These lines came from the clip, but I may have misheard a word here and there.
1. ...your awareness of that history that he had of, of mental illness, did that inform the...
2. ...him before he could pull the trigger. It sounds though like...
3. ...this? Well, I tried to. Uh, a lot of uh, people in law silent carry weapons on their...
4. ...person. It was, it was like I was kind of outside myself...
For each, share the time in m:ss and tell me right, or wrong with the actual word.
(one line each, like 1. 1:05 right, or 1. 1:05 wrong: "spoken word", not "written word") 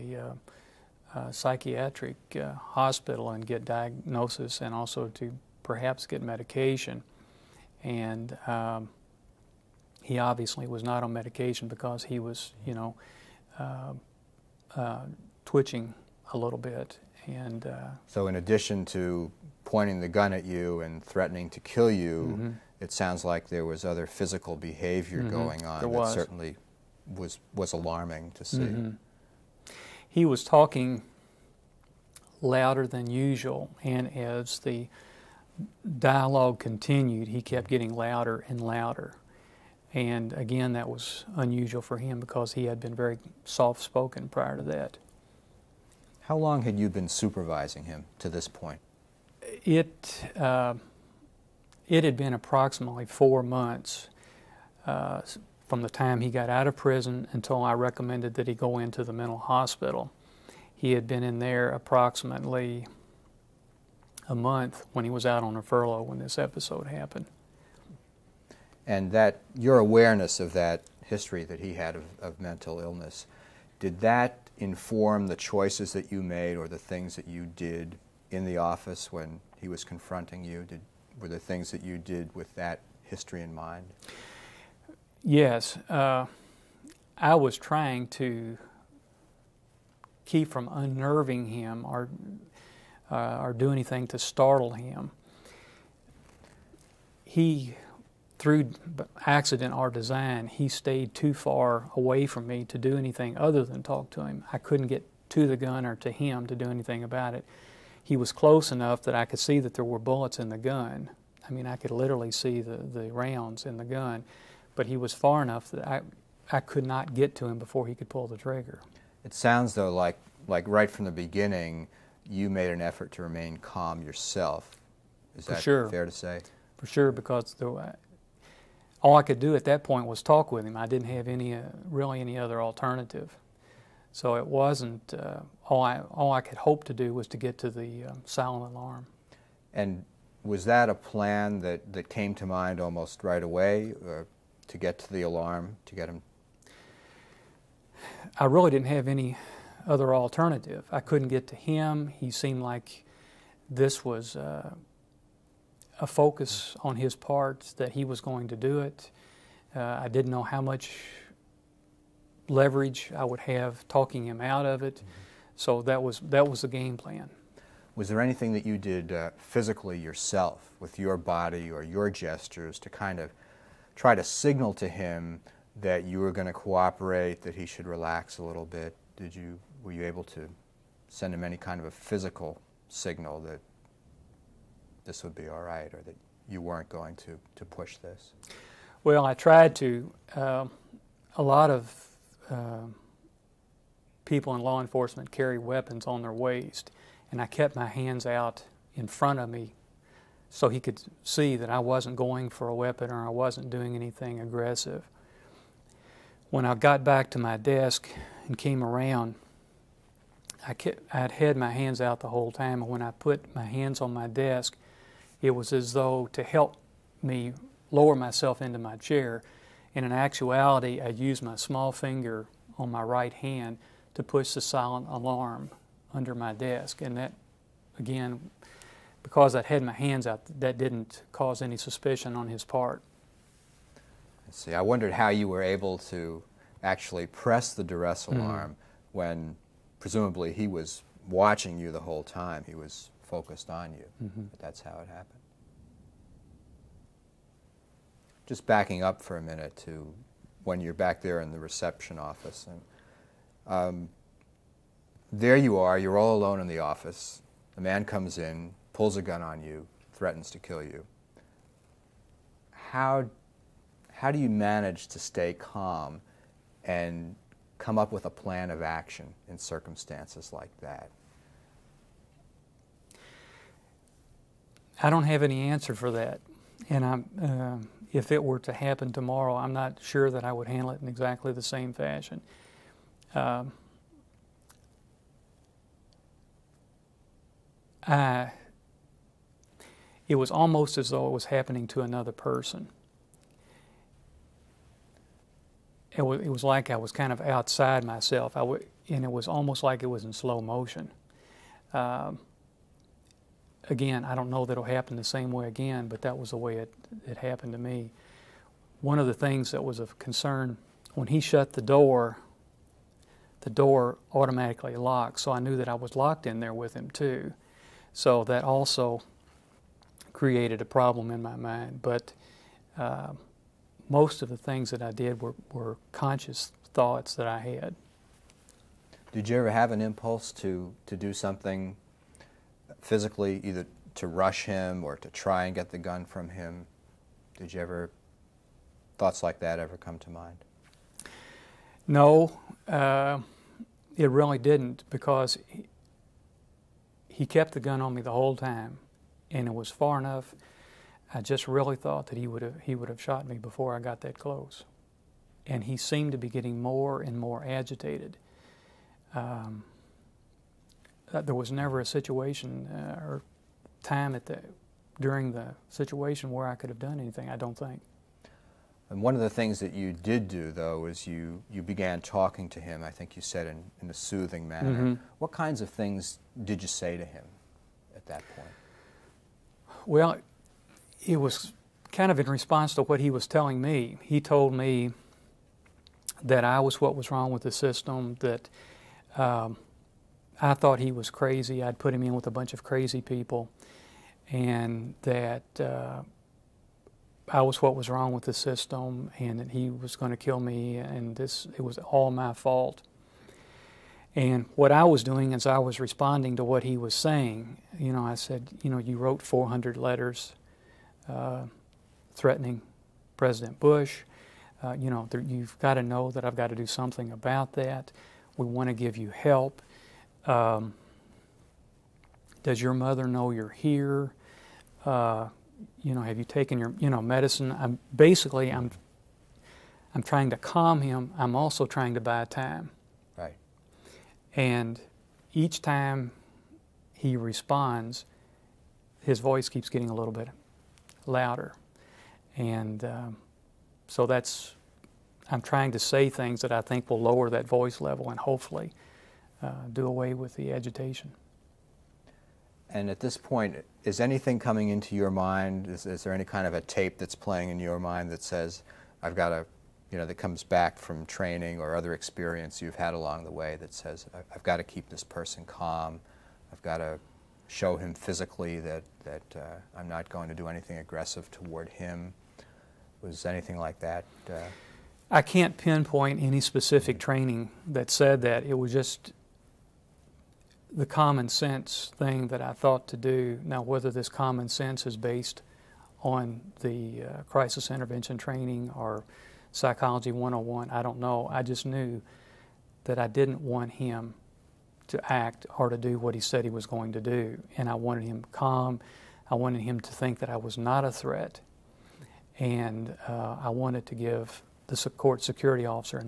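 1. 1:09 right
2. 1:57 right
3. 3:07 wrong: "enforcement", not "silent"
4. 4:52 right.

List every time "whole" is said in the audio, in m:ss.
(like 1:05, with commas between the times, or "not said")
3:32, 4:02, 5:48.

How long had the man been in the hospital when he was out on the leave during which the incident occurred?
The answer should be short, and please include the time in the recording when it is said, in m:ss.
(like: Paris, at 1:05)
1 month, at 1:01.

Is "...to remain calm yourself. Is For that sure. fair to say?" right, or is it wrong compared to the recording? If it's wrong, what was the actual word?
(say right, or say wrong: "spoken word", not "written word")
right.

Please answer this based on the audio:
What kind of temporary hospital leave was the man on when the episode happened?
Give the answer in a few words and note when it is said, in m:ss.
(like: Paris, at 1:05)
A furlough, at 1:05.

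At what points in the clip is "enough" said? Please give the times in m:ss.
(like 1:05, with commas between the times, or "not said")
1:48, 1:55, 5:50.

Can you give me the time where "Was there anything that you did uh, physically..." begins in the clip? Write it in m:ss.
2:47.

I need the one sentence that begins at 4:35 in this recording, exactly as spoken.
I don't have any answer for that.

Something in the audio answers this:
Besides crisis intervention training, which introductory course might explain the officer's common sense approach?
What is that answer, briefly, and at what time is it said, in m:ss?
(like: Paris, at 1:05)
Psychology 101, at 8:09.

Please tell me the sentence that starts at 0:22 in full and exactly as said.
it sounds like there was other physical behavior mm -hmm.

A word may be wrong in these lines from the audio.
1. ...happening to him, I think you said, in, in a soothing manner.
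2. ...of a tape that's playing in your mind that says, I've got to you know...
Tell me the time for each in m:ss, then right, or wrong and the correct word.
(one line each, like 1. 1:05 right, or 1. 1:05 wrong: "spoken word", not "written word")
1. 6:12 wrong: "talking", not "happening"
2. 7:36 right.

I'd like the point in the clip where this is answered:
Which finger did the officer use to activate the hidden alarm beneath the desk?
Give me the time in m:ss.
3:41.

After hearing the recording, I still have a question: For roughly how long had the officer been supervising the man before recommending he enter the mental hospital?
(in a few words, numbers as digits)
4 months.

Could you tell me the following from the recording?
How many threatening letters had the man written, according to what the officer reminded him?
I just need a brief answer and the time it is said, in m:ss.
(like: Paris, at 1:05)
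400, at 6:49.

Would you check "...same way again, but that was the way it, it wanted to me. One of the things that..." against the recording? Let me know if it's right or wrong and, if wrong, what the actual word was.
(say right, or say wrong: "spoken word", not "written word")
wrong: "happened", not "wanted".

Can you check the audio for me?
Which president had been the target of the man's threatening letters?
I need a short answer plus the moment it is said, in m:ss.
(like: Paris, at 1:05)
President Bush, at 6:53.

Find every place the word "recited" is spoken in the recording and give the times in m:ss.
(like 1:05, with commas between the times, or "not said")
not said.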